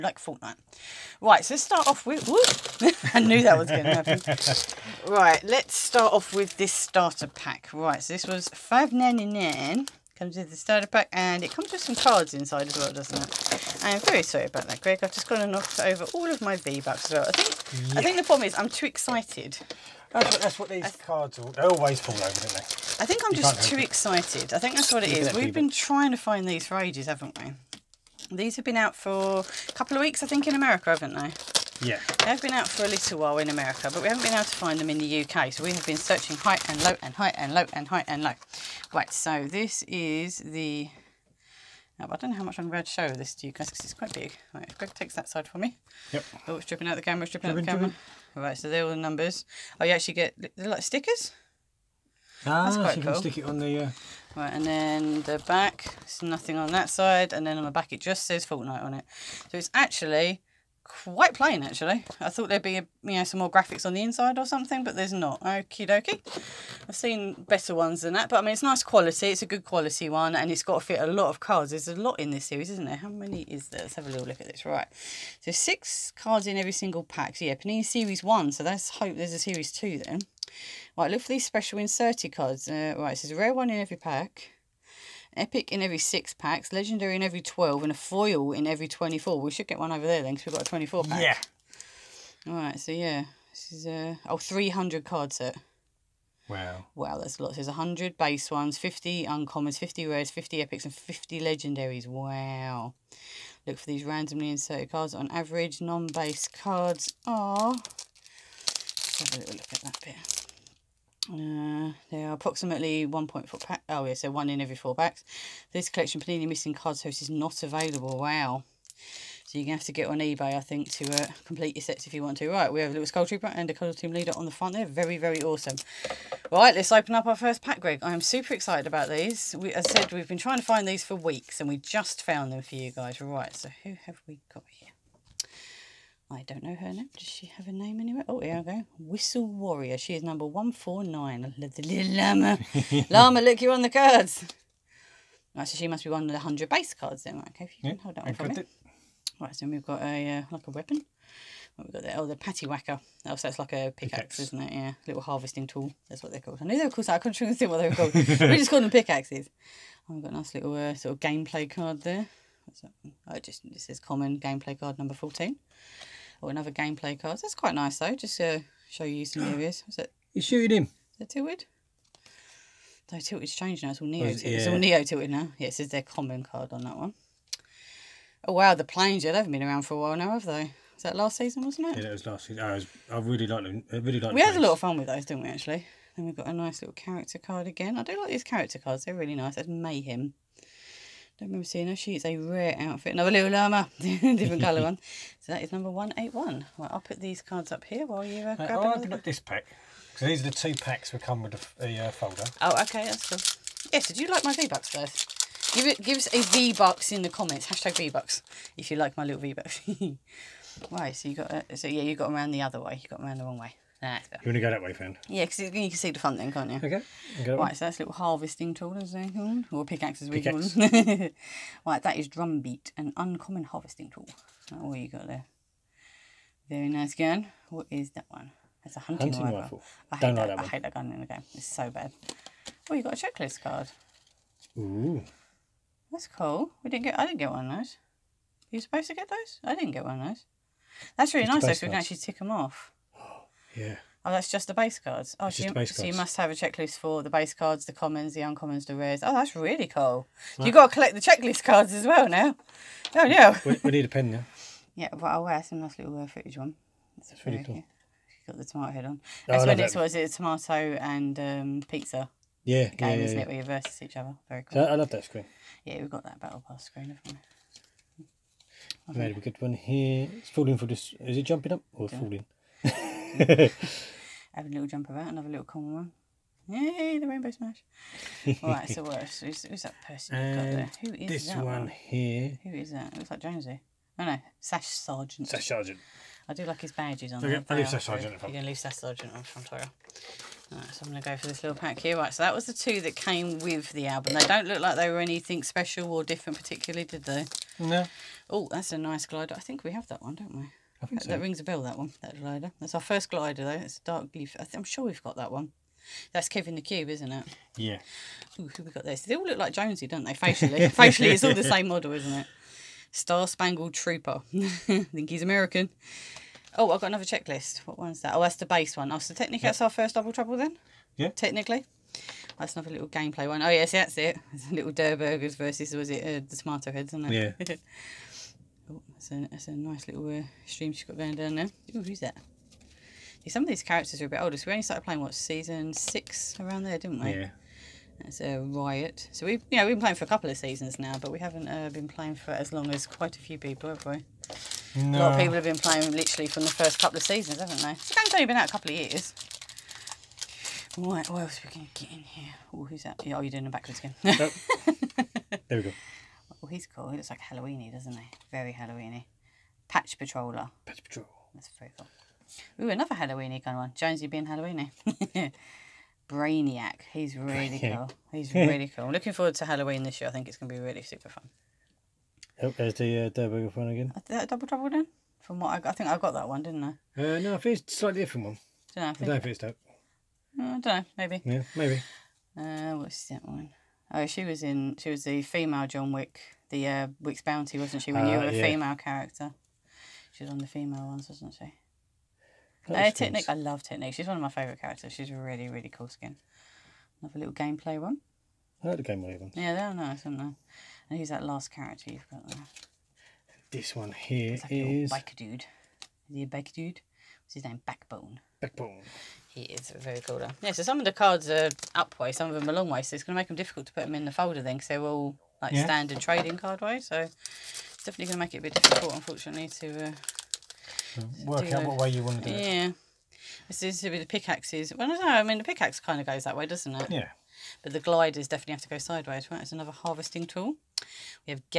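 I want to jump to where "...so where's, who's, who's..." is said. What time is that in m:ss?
4:38.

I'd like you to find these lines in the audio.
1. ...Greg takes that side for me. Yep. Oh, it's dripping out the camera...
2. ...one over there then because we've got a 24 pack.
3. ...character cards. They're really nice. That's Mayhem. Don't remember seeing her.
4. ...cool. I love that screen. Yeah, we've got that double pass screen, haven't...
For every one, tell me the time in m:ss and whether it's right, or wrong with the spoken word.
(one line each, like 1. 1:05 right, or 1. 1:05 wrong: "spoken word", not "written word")
1. 0:44 right
2. 1:29 right
3. 3:08 right
4. 4:24 wrong: "battle", not "double".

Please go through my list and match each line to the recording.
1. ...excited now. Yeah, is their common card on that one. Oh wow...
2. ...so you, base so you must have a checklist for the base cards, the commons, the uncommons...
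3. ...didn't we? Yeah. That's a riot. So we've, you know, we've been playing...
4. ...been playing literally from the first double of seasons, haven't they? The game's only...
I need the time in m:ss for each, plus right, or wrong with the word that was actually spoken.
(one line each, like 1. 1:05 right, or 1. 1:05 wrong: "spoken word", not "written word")
1. 2:55 wrong: "tilted", not "excited"
2. 4:05 right
3. 5:36 right
4. 5:45 wrong: "couple", not "double".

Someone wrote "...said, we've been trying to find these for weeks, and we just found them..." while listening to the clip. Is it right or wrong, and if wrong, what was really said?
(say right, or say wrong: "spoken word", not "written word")
right.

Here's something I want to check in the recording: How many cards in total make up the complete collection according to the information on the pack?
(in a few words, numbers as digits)
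300.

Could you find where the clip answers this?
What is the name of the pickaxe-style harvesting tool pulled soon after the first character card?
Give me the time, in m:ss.
2:32.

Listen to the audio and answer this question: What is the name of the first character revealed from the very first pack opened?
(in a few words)
Whistle Warrior.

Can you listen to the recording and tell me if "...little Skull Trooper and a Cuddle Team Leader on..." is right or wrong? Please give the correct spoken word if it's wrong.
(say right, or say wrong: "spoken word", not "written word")
right.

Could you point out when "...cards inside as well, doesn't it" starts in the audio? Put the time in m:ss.
0:11.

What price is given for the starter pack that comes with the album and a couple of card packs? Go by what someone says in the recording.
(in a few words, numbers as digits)
5.99.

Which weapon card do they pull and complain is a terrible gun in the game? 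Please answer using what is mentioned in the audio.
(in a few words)
Hunting rifle.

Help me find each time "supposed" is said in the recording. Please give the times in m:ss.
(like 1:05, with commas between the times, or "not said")
3:58.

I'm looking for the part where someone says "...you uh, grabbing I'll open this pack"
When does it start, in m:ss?
3:18.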